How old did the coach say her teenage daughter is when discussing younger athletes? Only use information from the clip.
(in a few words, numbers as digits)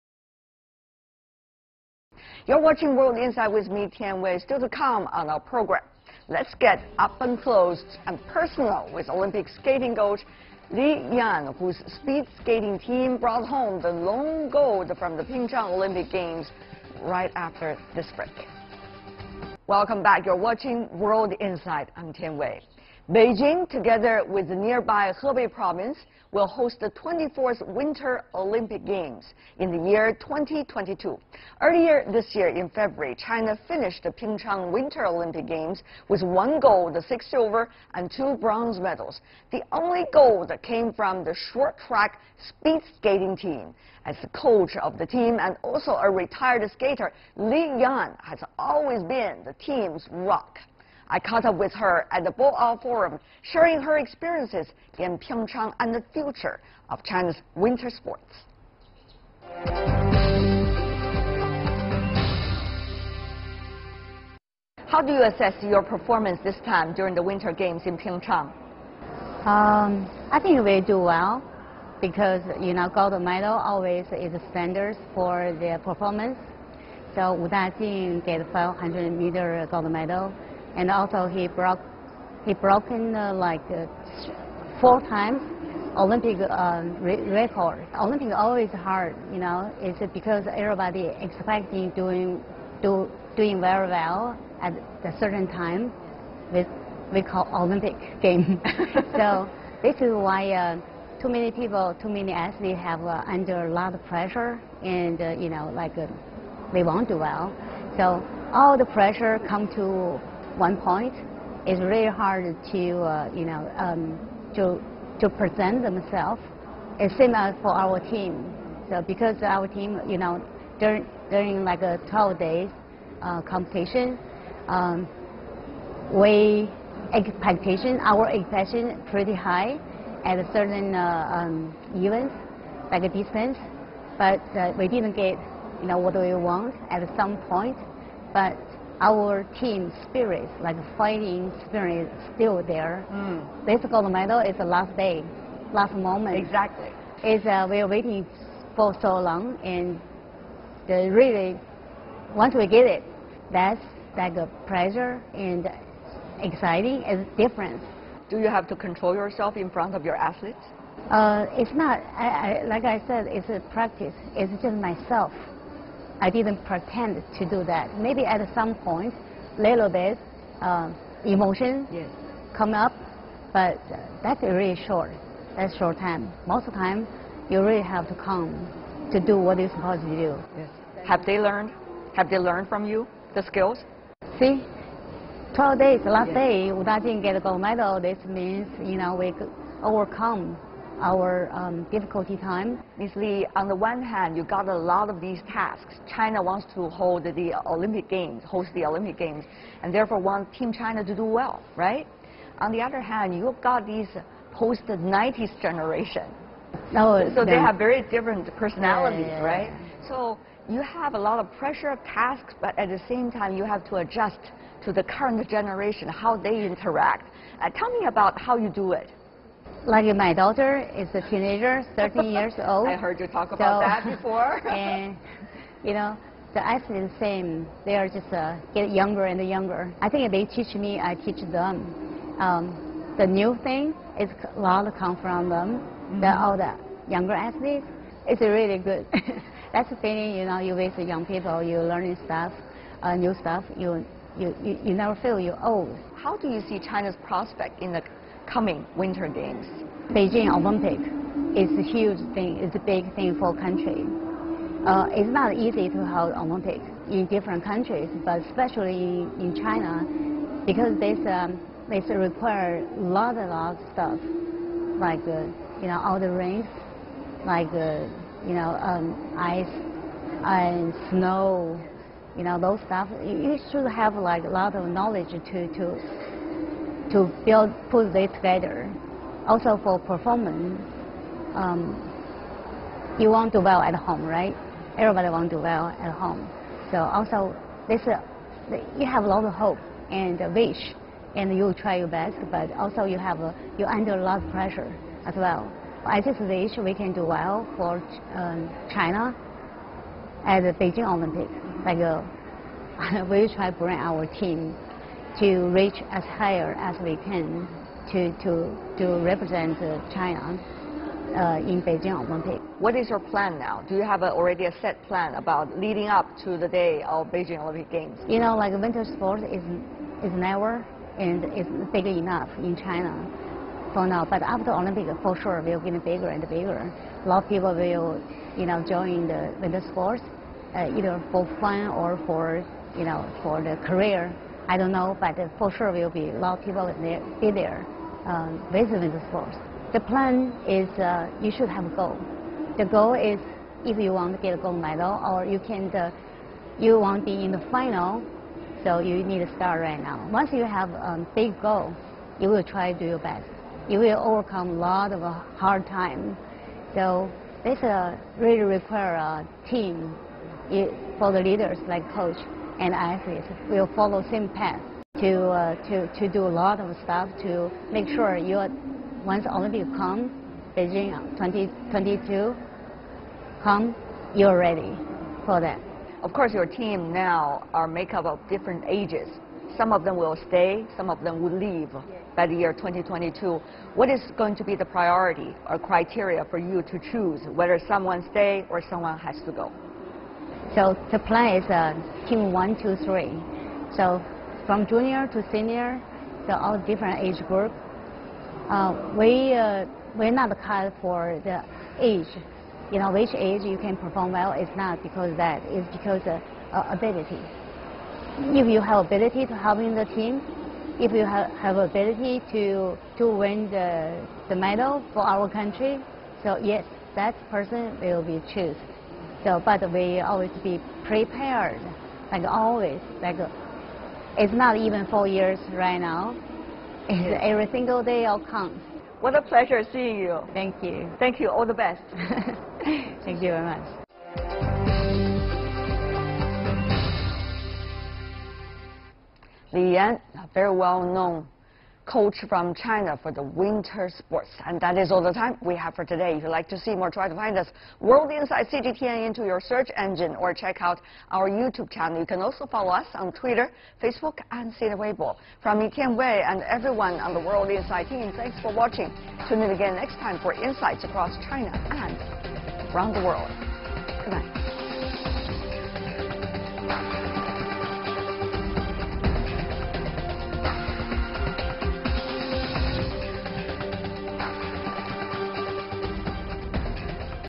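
13.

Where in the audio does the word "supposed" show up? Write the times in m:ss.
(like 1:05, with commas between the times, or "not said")
2:59.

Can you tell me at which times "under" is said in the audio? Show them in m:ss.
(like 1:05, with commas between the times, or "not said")
1:43, 4:53.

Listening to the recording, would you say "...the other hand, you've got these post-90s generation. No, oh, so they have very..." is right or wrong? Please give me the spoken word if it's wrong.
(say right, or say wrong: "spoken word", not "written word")
right.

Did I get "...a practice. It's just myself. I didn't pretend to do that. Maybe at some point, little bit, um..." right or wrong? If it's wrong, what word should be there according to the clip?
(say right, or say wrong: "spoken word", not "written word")
right.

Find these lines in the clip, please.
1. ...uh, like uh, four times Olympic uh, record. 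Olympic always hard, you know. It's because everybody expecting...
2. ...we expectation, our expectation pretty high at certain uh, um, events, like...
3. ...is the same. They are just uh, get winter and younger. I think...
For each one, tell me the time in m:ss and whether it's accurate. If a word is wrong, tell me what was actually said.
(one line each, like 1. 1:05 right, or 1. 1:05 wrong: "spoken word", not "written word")
1. 1:23 right
2. 2:06 right
3. 3:47 wrong: "younger", not "winter".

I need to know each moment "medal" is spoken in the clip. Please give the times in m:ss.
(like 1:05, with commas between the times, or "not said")
0:38, 1:13, 1:19, 2:24, 3:07, 5:44, 6:54.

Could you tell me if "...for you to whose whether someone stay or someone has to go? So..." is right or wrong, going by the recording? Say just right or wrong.
wrong.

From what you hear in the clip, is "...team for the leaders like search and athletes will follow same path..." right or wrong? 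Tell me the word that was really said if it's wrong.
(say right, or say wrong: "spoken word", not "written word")
wrong: "coach", not "search".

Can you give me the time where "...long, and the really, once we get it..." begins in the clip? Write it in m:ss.
2:29.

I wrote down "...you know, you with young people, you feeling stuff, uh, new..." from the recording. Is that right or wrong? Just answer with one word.
wrong.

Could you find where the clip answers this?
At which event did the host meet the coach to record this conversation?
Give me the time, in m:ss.
0:52.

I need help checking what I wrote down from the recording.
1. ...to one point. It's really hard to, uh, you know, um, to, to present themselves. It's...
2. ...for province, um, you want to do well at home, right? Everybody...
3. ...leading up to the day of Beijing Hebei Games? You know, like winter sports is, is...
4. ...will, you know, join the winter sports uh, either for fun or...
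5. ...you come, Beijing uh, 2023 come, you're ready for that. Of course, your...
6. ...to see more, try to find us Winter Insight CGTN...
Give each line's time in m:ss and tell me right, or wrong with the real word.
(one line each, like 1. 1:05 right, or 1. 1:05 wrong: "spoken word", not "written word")
1. 1:49 right
2. 4:39 wrong: "performance", not "province"
3. 5:15 wrong: "Olympic", not "Hebei"
4. 5:27 right
5. 6:09 wrong: "2022", not "2023"
6. 7:26 wrong: "World", not "Winter".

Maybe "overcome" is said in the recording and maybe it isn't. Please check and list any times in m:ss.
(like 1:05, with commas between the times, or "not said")
3:09, 5:54.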